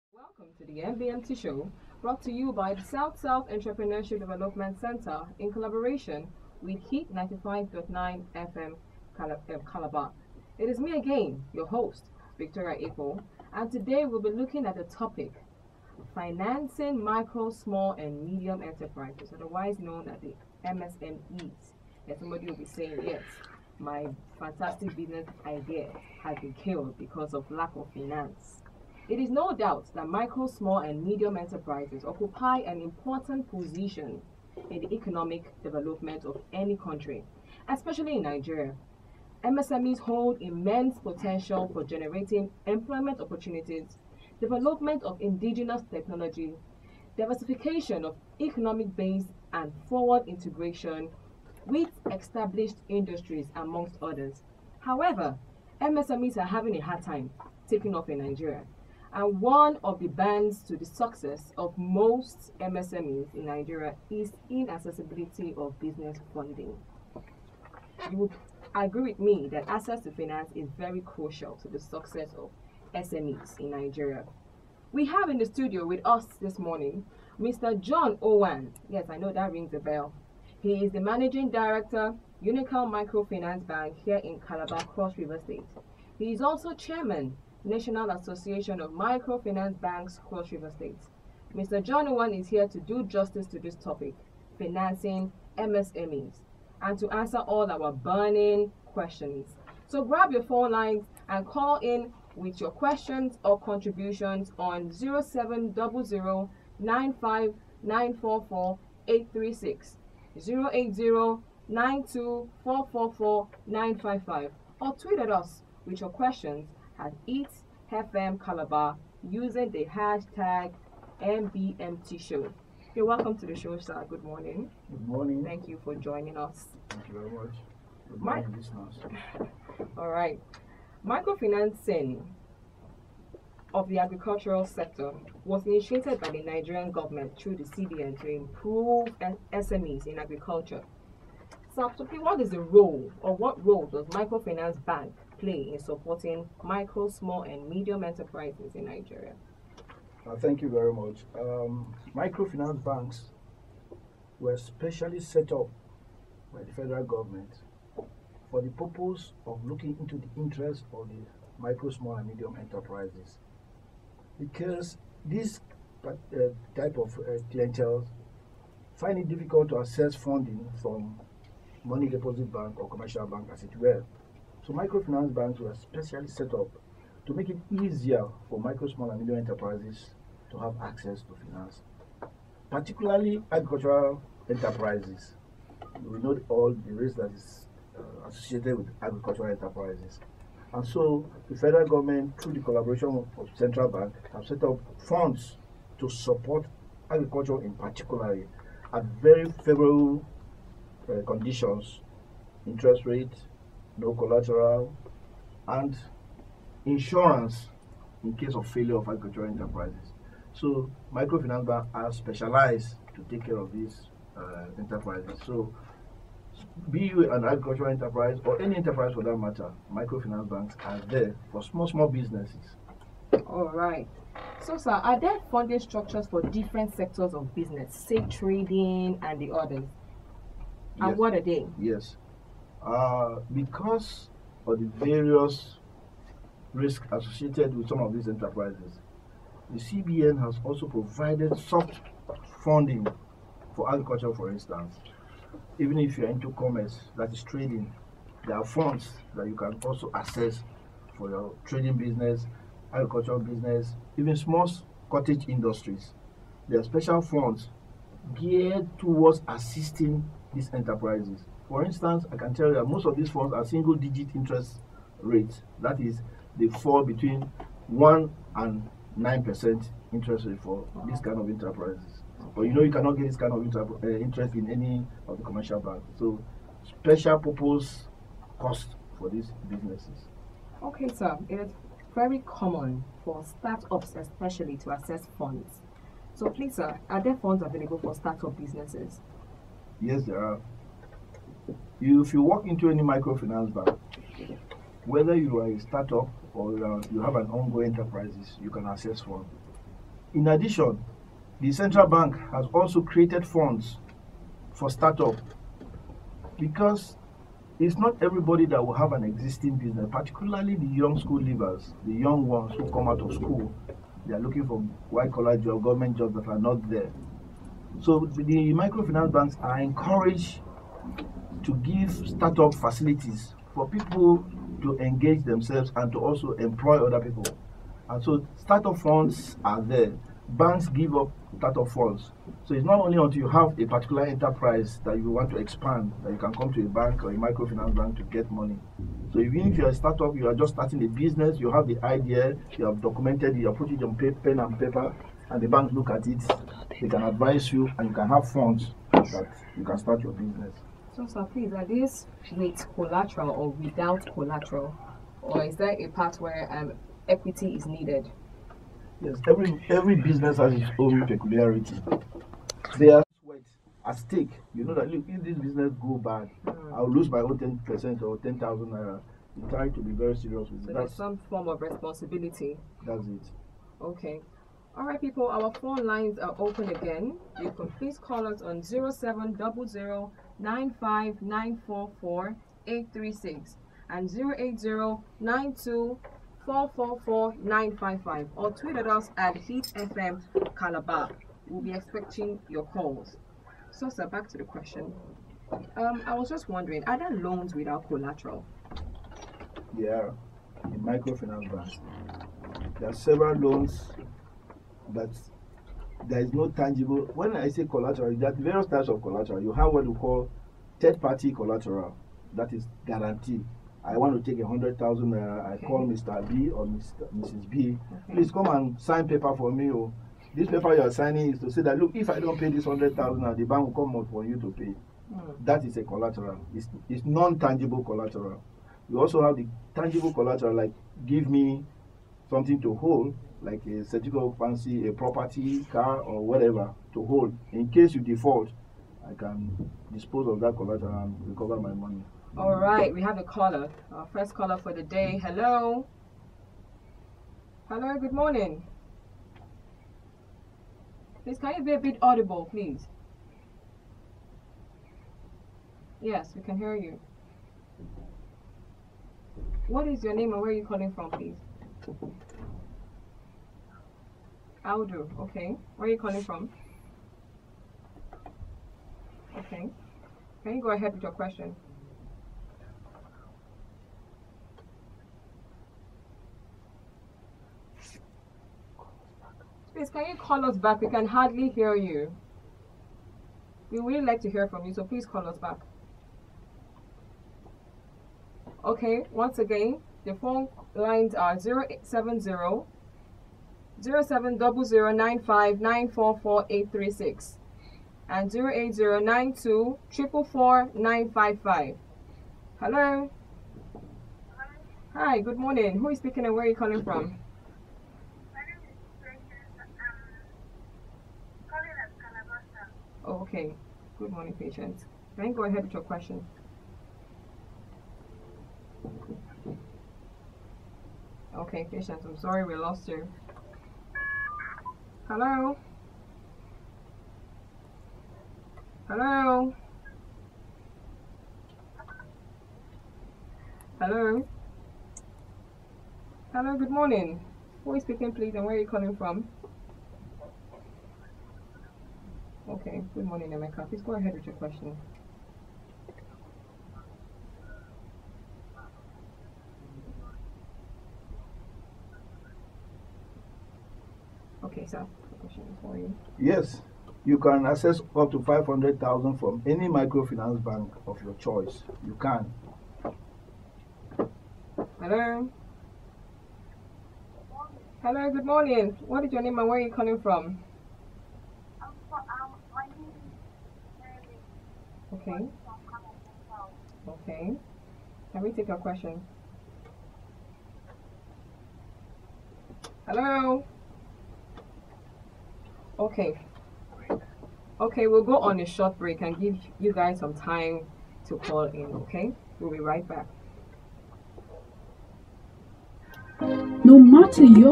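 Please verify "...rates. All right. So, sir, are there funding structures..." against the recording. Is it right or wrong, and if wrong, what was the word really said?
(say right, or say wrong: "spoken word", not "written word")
wrong: "businesses", not "rates".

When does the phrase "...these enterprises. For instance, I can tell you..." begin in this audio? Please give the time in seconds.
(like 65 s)
260 s.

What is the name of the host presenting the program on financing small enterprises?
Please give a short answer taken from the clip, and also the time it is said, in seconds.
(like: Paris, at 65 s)
Victoria April, at 12 s.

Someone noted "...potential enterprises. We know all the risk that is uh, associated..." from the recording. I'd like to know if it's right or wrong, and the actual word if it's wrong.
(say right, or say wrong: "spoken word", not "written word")
wrong: "agricultural", not "potential".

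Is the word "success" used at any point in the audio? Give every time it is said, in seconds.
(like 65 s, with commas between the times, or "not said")
60 s, 71 s.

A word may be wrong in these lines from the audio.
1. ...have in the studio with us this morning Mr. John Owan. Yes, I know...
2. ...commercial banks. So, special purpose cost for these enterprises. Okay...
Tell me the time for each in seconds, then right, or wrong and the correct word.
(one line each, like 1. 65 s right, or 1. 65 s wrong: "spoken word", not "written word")
1. 75 s right
2. 275 s wrong: "businesses", not "enterprises".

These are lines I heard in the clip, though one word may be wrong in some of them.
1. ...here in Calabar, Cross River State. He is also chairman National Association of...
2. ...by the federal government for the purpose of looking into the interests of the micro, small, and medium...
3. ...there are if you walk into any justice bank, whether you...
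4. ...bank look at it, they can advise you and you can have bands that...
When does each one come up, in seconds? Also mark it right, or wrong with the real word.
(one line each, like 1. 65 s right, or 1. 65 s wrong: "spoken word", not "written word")
1. 84 s right
2. 156 s right
3. 290 s wrong: "microfinance", not "justice"
4. 345 s wrong: "funds", not "bands".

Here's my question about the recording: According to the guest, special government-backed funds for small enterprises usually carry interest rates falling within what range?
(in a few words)
1 to 9%.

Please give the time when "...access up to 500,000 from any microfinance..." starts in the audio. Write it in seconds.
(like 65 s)
557 s.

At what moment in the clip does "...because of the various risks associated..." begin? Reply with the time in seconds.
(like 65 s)
233 s.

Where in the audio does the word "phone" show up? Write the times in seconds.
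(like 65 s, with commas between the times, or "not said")
100 s, 375 s, 490 s.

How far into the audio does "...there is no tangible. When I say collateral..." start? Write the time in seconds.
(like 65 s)
406 s.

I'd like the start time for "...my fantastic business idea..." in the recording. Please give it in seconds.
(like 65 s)
23 s.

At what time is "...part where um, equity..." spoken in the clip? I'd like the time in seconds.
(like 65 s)
356 s.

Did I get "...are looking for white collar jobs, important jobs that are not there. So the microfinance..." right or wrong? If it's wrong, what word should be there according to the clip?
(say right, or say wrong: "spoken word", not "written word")
wrong: "government", not "important".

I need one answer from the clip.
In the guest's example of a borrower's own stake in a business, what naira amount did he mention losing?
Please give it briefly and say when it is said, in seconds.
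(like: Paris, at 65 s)
10,000 naira, at 368 s.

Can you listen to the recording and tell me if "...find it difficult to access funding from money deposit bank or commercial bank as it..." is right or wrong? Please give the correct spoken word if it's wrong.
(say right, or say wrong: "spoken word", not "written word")
right.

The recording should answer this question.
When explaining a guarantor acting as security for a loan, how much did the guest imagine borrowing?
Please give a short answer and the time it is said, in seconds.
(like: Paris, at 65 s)
100,000, at 414 s.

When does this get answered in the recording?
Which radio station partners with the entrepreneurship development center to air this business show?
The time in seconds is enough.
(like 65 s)
6 s.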